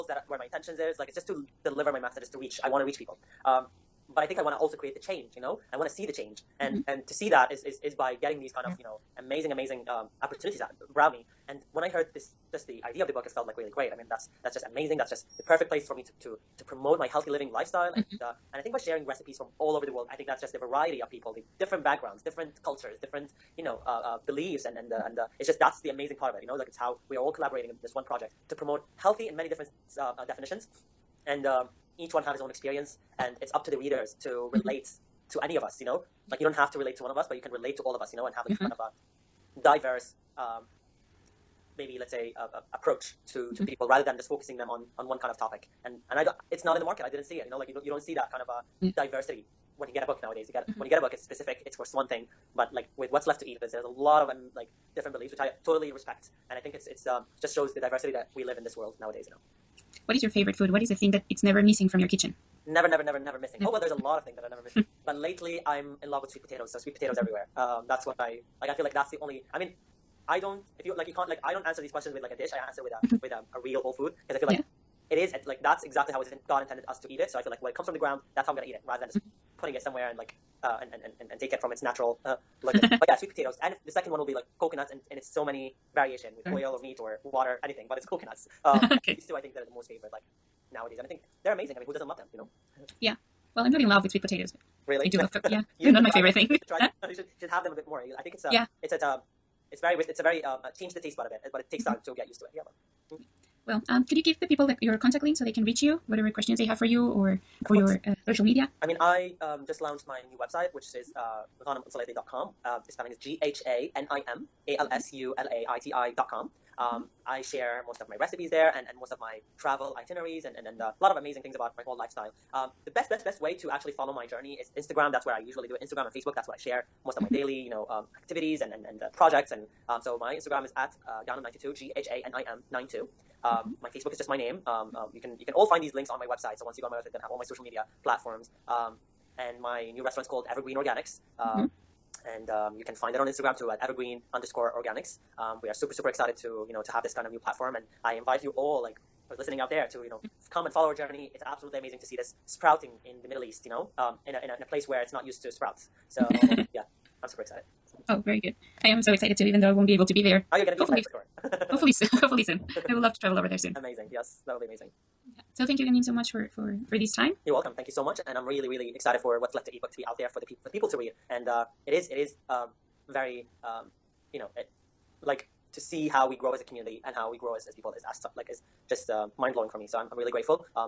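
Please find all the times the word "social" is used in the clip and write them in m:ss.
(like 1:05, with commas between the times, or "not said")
1:48, 2:17.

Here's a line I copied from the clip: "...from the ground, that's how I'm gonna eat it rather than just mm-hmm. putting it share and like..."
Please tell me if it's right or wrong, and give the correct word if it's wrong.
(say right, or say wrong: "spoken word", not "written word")
wrong: "somewhere", not "share".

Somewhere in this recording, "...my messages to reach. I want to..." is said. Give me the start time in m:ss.
0:01.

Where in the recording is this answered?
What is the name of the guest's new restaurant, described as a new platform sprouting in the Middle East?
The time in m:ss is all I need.
2:20.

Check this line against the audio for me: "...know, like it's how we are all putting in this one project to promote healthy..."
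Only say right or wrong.
wrong.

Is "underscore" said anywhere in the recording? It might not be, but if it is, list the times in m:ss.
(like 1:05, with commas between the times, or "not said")
2:24.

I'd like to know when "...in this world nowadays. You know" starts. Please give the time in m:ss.
0:58.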